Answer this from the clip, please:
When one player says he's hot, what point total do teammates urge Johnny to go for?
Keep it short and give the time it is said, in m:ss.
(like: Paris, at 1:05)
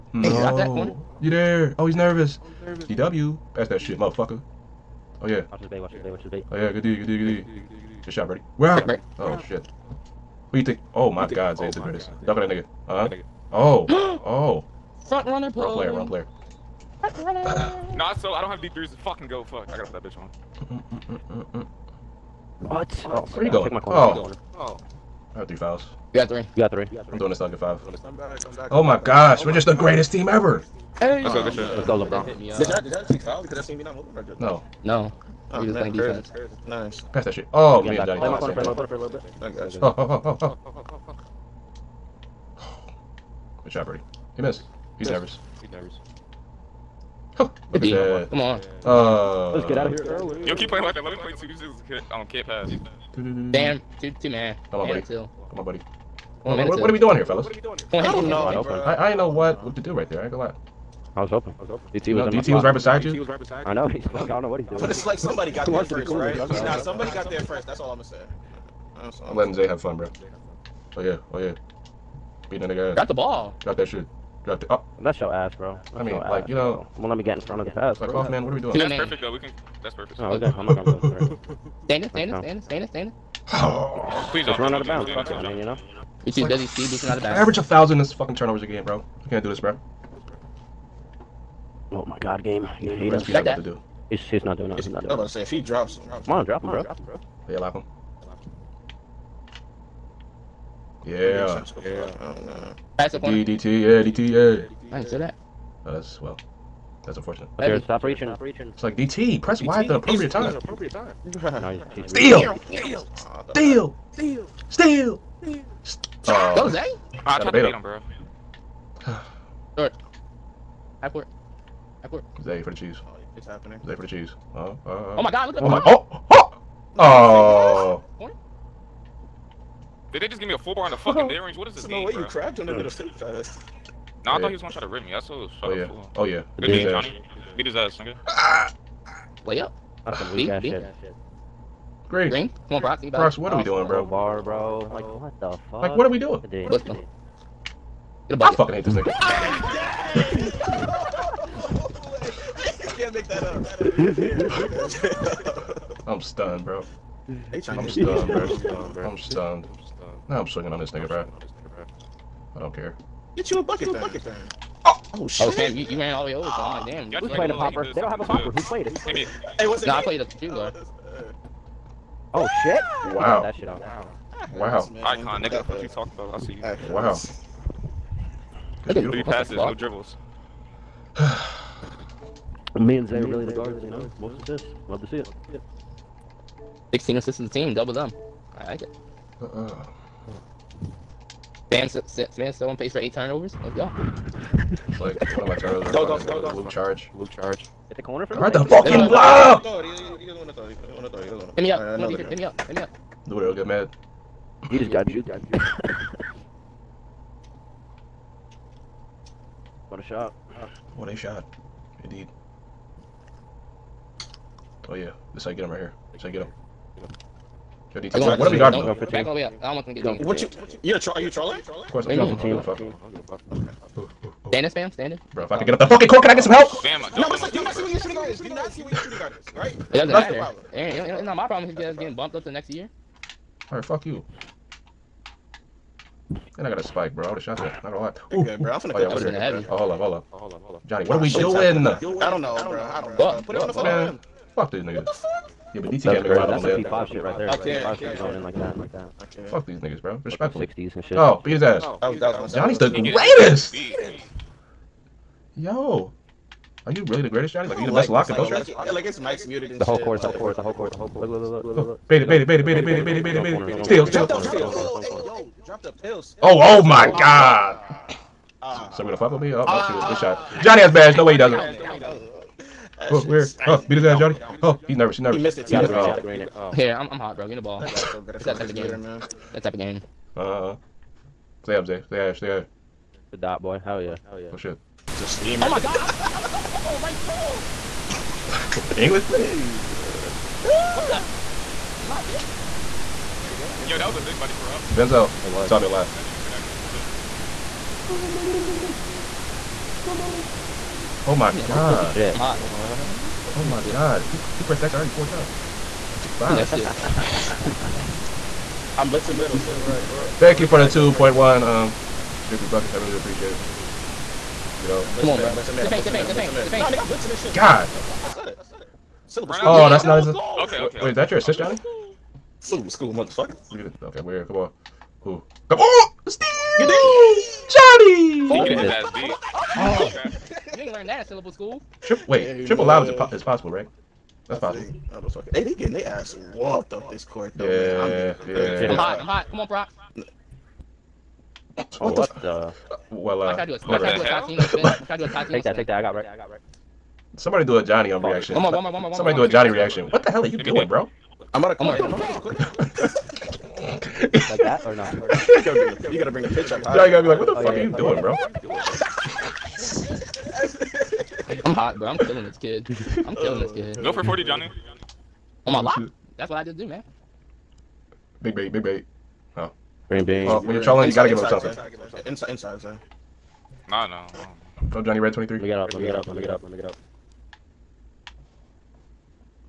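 40, at 6:04.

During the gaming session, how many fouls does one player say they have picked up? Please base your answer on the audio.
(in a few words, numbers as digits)
3.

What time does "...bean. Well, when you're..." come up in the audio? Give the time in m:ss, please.
6:10.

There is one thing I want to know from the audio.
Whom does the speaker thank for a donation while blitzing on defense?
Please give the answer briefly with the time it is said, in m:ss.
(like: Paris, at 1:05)
Strictly Buckets, at 5:12.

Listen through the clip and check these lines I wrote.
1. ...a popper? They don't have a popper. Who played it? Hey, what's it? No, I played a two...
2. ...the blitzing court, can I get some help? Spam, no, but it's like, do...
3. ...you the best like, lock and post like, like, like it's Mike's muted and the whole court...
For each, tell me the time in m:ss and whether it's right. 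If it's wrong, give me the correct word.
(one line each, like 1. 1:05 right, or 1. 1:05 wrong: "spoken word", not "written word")
1. 2:47 right
2. 3:45 wrong: "fucking", not "blitzing"
3. 4:17 right.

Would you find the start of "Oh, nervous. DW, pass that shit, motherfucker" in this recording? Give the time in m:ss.
0:02.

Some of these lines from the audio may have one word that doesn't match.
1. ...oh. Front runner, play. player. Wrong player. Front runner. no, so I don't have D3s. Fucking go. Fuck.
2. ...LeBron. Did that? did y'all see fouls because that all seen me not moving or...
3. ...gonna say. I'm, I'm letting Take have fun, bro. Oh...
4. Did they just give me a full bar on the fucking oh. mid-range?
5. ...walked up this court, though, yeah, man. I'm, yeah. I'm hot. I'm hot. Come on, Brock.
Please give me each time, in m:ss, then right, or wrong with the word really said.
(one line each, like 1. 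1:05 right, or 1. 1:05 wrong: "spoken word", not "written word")
1. 0:14 right
2. 0:32 right
3. 1:07 wrong: "Zay", not "Take"
4. 2:10 right
5. 5:36 right.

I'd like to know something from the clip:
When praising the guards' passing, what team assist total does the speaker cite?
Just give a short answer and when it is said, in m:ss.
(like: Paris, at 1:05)
16, at 3:06.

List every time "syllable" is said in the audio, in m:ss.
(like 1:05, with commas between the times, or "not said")
5:22, 5:31.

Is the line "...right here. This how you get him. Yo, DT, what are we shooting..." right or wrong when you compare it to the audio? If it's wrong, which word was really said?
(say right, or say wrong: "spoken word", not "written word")
wrong: "guarding", not "shooting".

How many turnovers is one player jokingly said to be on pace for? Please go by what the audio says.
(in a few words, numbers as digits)
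8.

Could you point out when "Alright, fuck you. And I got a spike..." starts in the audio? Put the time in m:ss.
3:53.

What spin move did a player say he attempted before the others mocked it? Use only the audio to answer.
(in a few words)
Tatino spin.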